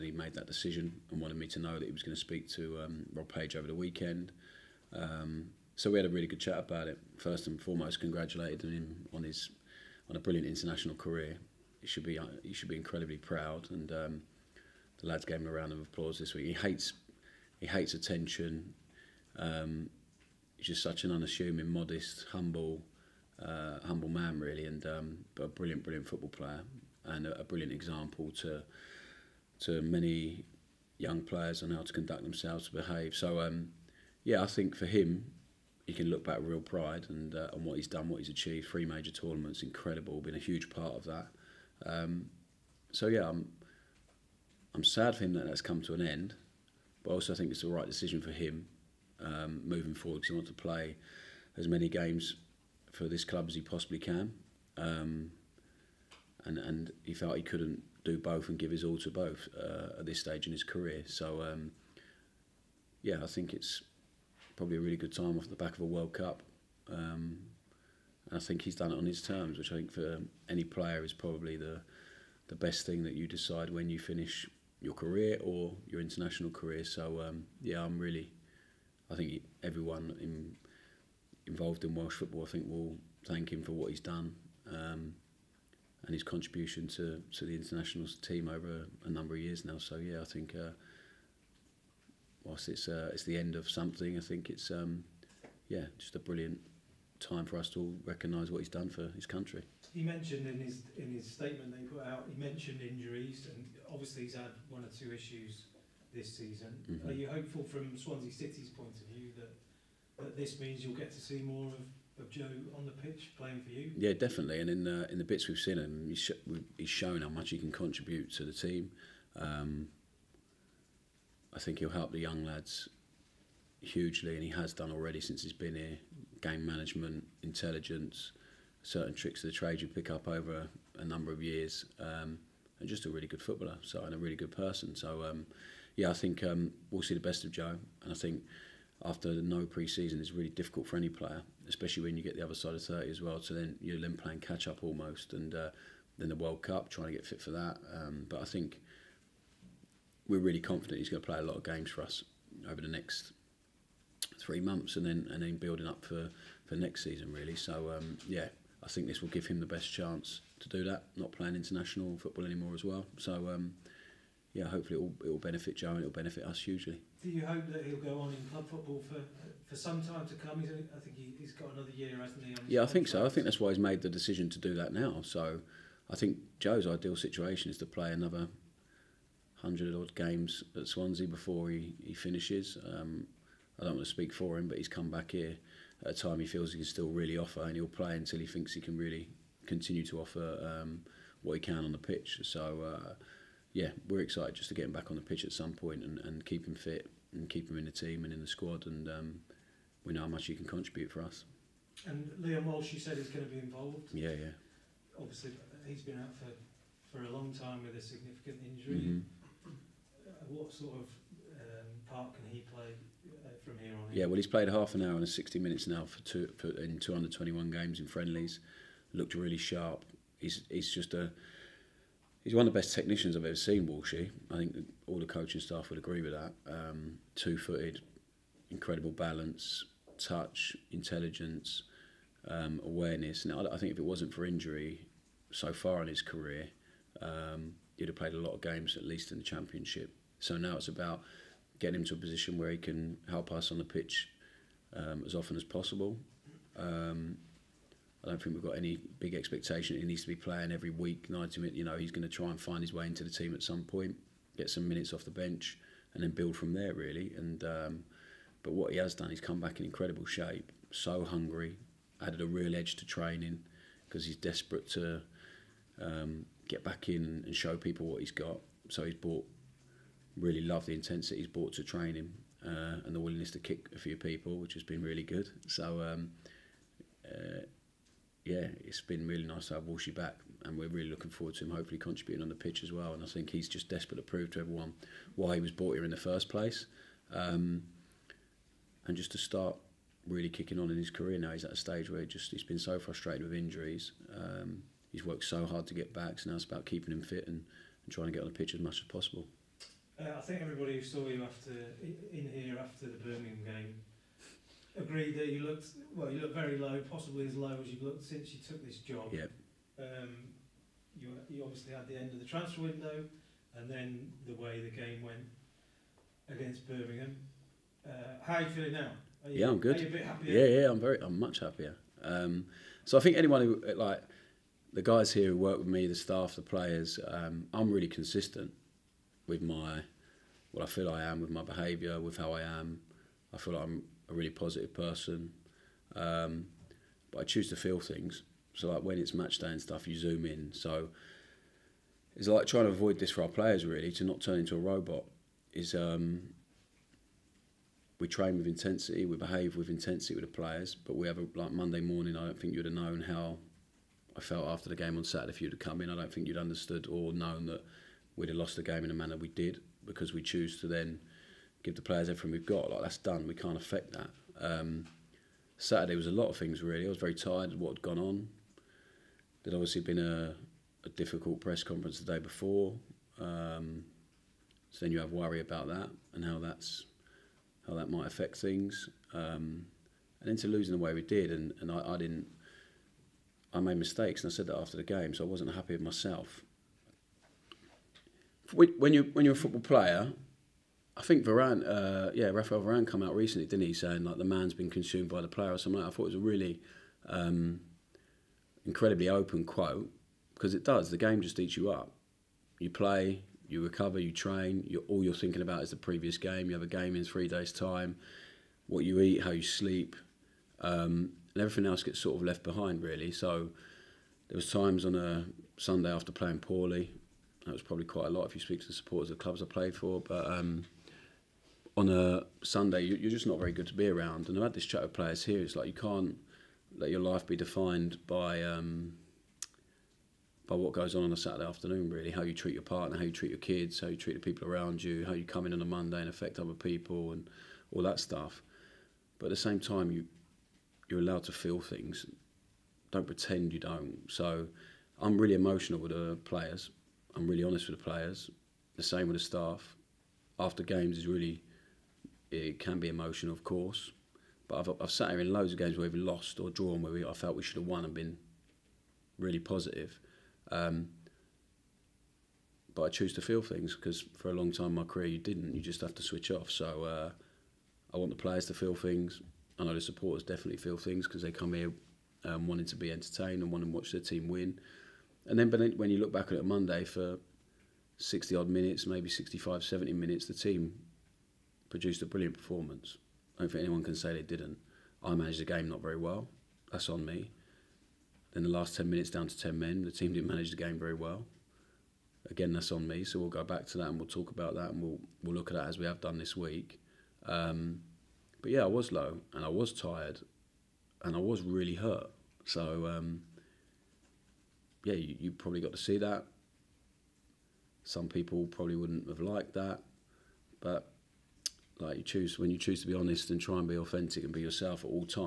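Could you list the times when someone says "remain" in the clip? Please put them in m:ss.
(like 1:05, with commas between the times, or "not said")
not said.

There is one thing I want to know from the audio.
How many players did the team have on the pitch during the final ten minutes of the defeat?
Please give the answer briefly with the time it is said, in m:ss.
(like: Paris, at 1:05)
10, at 8:09.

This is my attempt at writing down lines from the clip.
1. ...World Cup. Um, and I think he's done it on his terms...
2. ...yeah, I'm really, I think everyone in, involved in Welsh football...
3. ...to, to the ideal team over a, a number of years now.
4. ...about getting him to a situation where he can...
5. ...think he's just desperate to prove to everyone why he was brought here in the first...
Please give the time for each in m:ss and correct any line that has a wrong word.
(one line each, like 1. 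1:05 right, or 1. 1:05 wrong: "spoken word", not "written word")
1. 1:05 right
2. 1:17 right
3. 1:26 wrong: "international", not "ideal"
4. 4:00 wrong: "position", not "situation"
5. 4:43 right.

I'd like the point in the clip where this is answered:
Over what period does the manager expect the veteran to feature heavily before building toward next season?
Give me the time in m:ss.
2:32.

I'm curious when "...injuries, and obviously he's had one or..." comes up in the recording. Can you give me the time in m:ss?
1:42.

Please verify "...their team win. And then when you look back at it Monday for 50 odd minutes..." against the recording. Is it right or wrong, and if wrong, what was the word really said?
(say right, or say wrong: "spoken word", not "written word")
wrong: "60", not "50".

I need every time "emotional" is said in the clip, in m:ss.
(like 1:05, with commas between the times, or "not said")
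7:25, 7:33.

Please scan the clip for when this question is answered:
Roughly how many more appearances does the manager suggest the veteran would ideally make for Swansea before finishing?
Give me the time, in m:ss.
2:58.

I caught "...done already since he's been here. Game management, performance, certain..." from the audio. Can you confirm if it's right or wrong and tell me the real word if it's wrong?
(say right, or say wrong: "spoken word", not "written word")
wrong: "intelligence", not "performance".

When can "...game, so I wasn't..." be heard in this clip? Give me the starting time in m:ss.
6:25.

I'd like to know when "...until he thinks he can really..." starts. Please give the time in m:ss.
3:08.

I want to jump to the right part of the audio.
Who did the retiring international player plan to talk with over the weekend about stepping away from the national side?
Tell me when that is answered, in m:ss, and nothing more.
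0:03.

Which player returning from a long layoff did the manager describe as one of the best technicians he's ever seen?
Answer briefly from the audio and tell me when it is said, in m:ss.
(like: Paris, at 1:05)
Liam Walsh, at 3:22.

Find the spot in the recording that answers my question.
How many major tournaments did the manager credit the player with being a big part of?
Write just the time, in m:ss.
0:38.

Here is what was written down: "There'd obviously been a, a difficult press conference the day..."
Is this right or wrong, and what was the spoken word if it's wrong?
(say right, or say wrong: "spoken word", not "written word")
right.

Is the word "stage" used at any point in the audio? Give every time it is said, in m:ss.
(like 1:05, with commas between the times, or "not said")
1:00, 4:51.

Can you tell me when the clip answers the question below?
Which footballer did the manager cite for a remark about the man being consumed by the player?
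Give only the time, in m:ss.
6:32.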